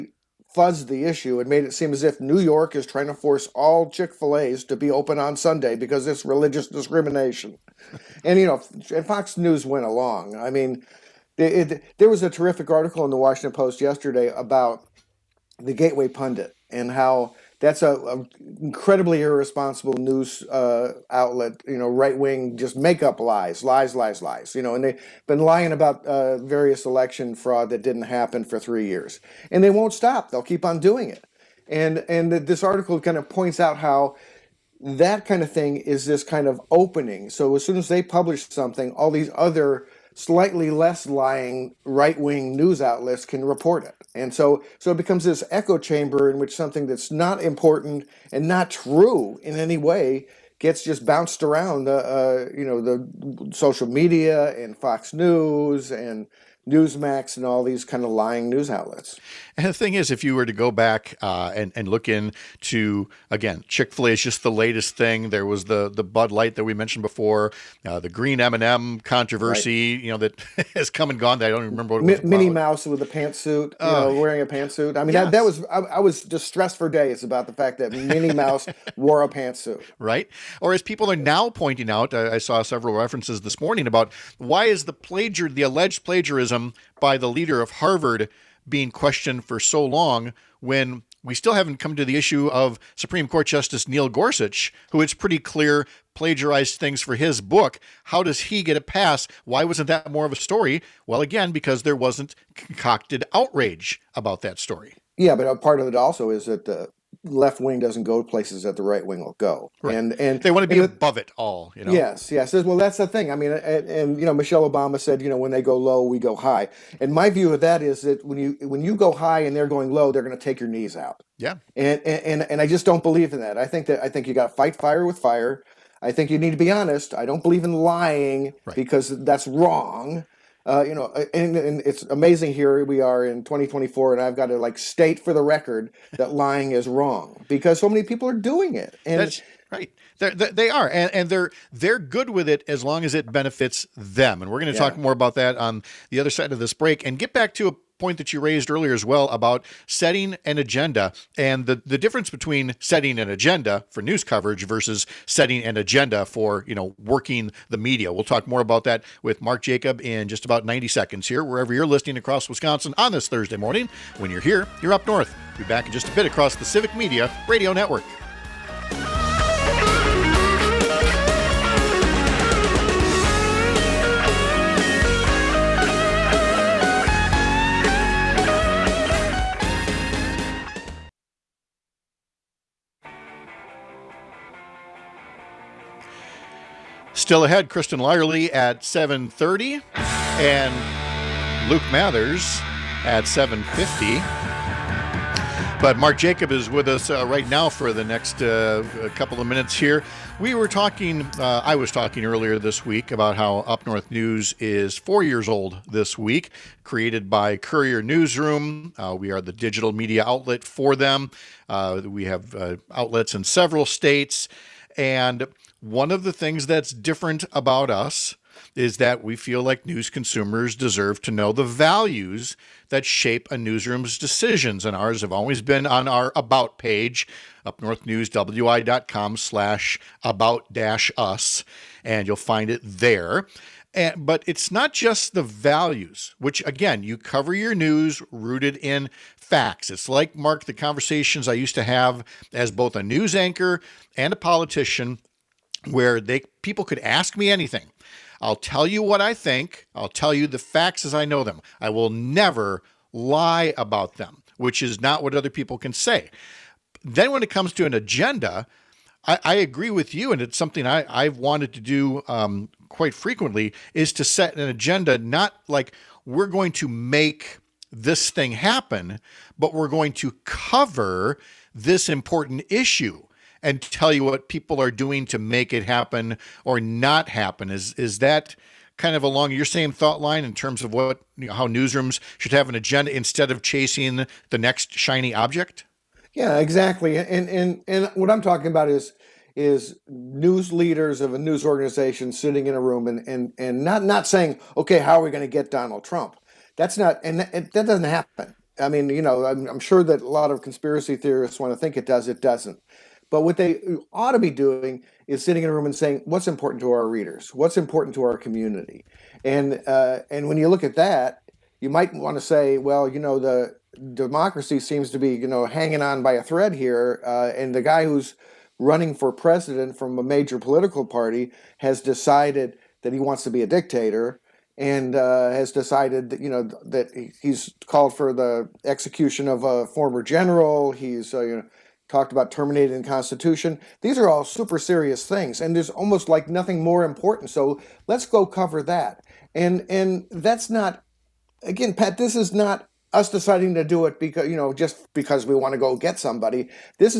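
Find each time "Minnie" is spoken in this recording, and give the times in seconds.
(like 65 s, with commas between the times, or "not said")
72 s, 77 s.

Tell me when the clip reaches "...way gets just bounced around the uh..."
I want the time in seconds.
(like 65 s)
49 s.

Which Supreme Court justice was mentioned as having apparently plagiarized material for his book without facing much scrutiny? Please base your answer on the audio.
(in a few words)
Neil Gorsuch.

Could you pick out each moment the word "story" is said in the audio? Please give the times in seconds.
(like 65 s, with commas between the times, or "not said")
100 s, 104 s.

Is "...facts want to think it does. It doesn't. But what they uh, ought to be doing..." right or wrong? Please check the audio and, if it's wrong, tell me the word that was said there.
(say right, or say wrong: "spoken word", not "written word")
wrong: "theorists", not "facts".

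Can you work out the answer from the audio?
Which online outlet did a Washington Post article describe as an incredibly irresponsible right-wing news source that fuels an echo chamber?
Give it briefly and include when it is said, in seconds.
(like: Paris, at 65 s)
Gateway Pundit, at 15 s.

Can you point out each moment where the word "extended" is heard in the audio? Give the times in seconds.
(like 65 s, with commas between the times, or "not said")
not said.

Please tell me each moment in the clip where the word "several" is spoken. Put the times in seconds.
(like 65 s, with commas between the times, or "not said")
82 s, 213 s.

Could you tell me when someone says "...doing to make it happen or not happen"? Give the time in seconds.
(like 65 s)
274 s.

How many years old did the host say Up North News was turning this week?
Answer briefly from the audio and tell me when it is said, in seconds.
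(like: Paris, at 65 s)
4, at 204 s.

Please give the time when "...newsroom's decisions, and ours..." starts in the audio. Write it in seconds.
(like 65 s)
223 s.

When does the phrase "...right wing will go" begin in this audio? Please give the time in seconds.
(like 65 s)
108 s.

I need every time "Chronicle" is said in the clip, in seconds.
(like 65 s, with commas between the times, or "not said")
not said.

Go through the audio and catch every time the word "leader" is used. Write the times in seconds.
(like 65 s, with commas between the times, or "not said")
87 s, 290 s.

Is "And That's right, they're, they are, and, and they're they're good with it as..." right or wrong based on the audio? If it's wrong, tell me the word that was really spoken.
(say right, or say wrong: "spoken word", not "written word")
right.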